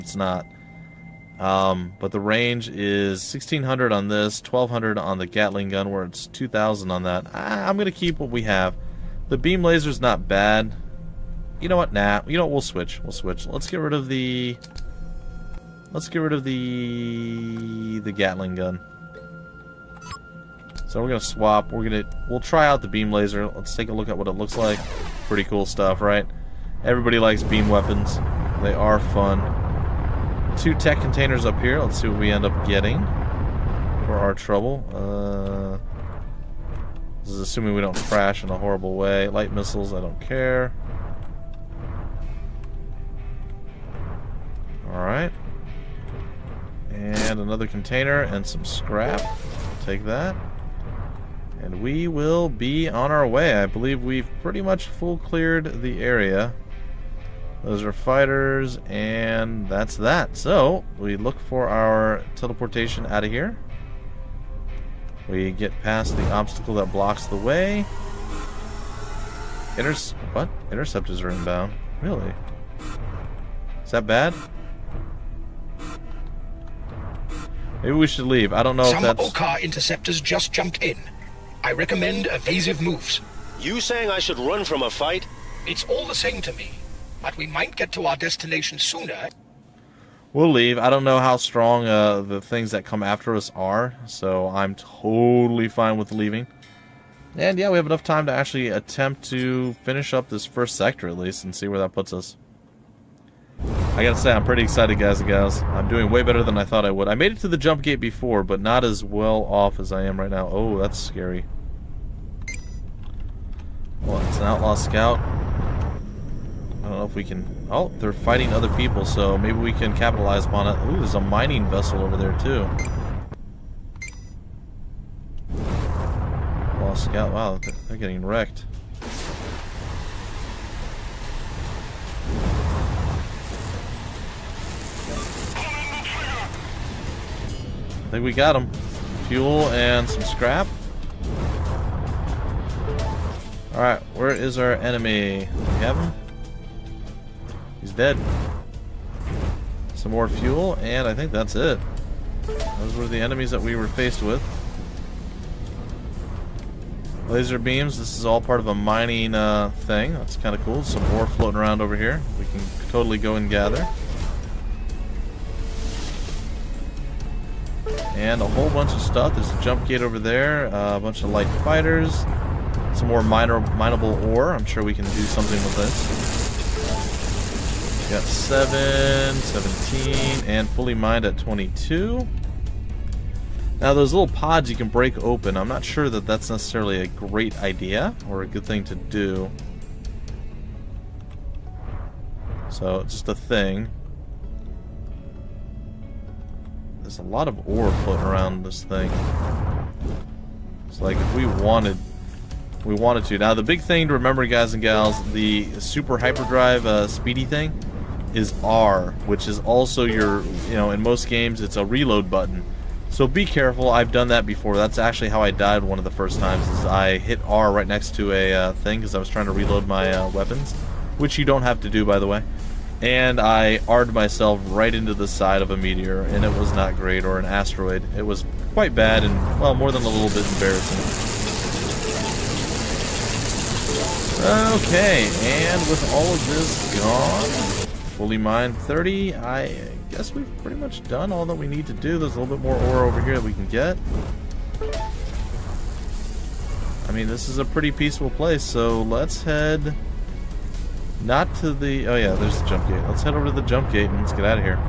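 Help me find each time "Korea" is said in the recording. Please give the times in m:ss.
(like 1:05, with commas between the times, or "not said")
not said.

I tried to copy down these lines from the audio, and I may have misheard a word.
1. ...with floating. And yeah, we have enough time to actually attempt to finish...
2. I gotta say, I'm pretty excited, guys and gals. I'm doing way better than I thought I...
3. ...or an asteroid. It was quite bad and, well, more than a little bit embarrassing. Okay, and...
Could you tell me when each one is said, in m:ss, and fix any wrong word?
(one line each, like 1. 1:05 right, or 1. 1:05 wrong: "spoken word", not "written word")
1. 1:35 wrong: "leaving", not "floating"
2. 1:43 right
3. 3:47 right.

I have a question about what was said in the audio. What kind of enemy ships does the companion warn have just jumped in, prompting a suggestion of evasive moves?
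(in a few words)
Okkar interceptors.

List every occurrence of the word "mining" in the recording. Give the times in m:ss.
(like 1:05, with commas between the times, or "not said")
2:01, 2:38.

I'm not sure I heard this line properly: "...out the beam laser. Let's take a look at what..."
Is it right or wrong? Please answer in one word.
right.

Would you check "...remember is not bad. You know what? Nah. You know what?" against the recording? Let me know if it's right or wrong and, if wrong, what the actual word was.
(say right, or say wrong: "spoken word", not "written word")
wrong: "laser", not "remember".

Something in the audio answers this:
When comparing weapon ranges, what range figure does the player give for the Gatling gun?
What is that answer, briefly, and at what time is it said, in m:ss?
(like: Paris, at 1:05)
1200, at 0:04.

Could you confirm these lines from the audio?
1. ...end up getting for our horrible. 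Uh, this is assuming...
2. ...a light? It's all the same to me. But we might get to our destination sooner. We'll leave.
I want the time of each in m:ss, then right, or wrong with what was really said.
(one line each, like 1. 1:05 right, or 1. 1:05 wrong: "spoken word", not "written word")
1. 0:32 wrong: "trouble", not "horrible"
2. 1:24 wrong: "fight", not "light".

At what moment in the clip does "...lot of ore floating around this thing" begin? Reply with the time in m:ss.
3:17.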